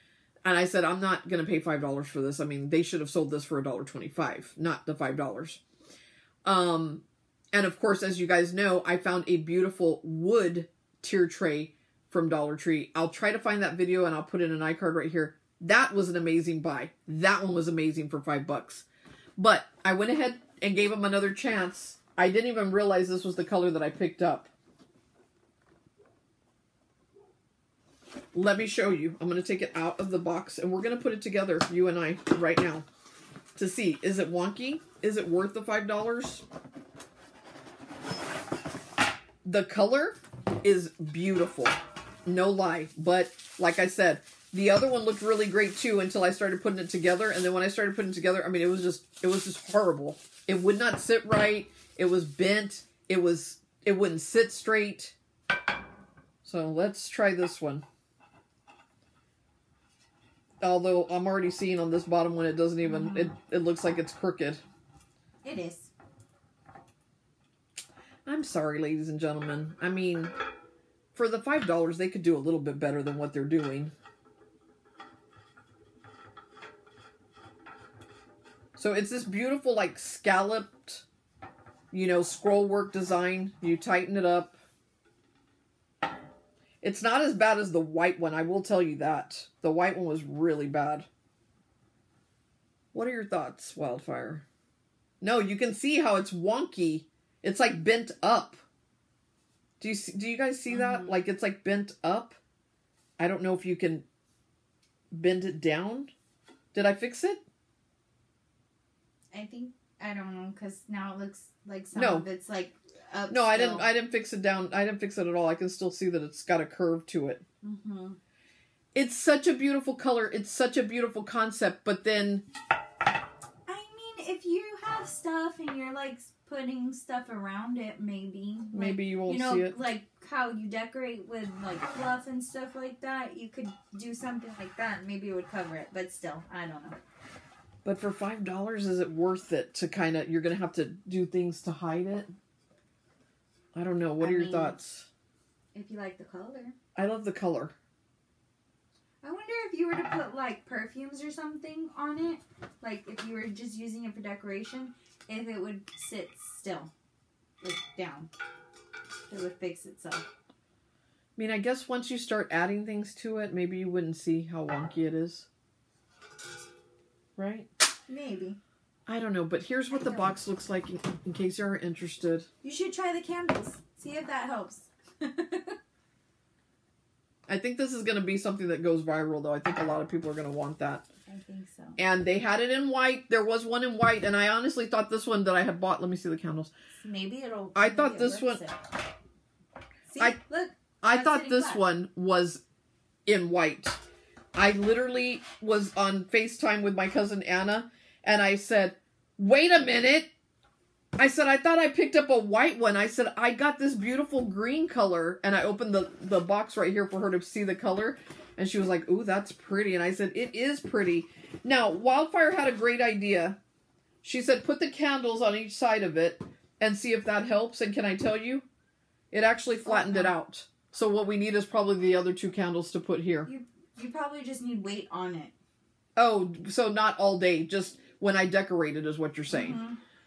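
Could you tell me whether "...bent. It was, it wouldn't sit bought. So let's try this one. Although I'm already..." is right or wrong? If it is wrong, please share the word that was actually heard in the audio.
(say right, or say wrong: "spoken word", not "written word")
wrong: "straight", not "bought".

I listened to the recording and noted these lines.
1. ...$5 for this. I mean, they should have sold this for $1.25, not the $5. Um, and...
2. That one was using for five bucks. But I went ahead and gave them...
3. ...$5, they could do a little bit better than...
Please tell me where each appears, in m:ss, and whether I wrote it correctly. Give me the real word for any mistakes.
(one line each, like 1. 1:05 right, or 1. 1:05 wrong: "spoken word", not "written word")
1. 0:01 right
2. 0:17 wrong: "amazing", not "using"
3. 1:11 right.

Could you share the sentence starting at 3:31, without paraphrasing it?
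Now, Wildfire had a great idea.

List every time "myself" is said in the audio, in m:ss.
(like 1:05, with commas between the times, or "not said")
not said.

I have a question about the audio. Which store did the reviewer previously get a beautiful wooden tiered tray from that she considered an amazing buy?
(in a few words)
Dollar Tree.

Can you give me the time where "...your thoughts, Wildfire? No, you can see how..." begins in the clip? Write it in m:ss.
1:33.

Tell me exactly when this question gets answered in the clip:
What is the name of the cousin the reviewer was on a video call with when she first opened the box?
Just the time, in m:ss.
3:17.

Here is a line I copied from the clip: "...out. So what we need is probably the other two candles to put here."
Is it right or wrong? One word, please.
right.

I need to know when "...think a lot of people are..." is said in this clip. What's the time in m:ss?
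2:59.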